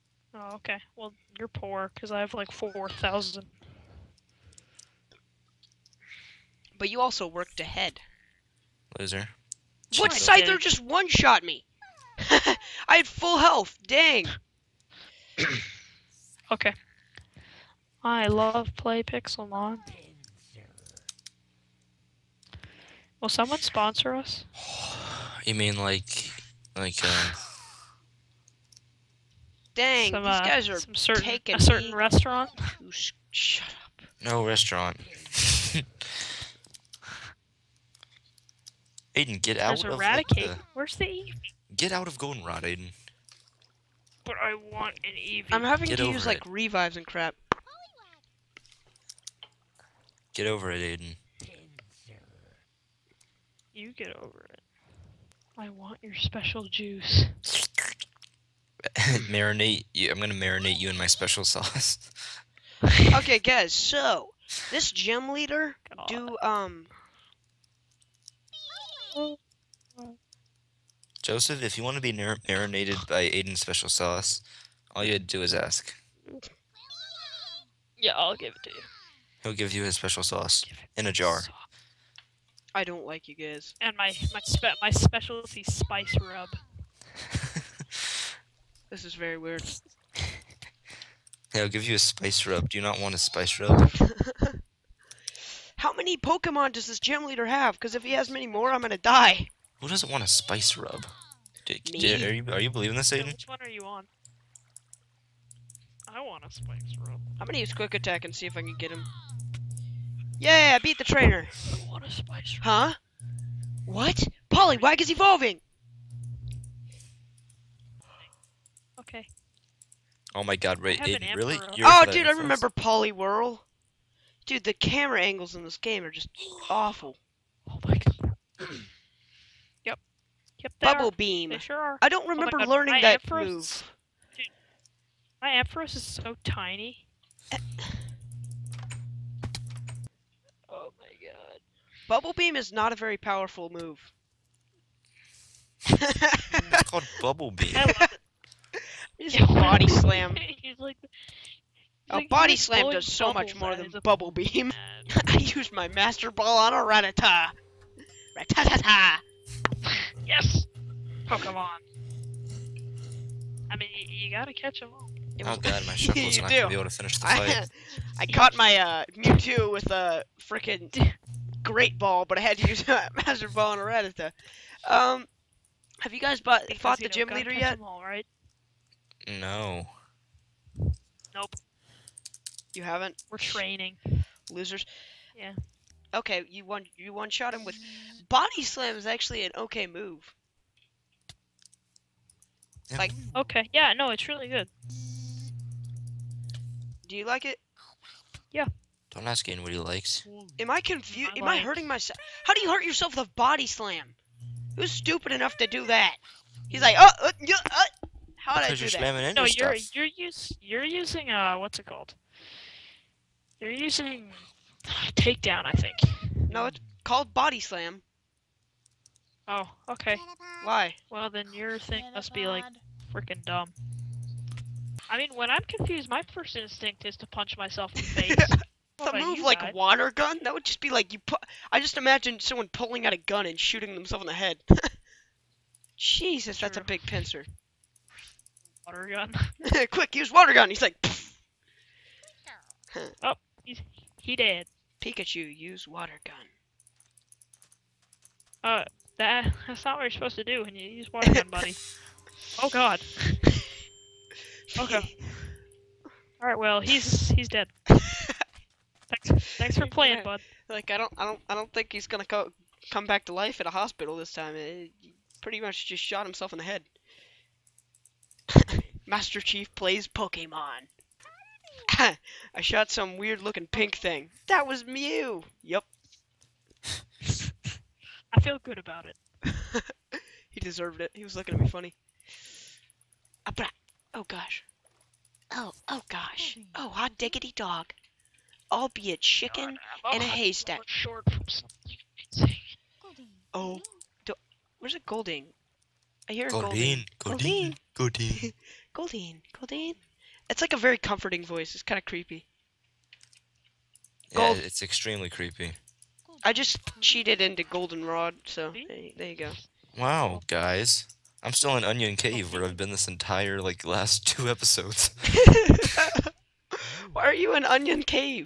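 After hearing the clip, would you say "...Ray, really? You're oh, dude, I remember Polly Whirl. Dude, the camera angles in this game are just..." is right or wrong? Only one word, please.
right.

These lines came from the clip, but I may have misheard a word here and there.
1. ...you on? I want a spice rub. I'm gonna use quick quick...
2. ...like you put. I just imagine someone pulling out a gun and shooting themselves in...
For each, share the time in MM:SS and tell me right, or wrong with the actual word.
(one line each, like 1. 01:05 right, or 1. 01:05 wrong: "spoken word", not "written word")
1. 01:43 wrong: "attack", not "quick"
2. 03:50 right.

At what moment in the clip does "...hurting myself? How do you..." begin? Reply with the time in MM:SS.
03:21.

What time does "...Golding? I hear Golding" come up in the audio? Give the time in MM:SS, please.
04:55.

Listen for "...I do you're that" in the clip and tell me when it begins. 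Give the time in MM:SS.
03:28.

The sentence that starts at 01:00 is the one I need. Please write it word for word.
I'm gonna marinate you in my special sauce.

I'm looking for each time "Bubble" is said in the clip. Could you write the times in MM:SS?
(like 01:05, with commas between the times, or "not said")
02:10, 02:22, 02:27, 02:34.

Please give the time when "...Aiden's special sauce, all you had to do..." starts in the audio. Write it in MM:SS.
01:13.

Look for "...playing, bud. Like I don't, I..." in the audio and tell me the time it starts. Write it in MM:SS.
04:19.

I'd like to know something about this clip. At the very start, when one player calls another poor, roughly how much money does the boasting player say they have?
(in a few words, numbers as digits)
4000.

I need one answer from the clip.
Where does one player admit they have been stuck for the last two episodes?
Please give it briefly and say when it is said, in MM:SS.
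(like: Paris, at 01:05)
Union Cave, at 05:11.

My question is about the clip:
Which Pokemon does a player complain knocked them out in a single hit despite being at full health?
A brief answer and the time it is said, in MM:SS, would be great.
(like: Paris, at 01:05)
Scyther, at 00:10.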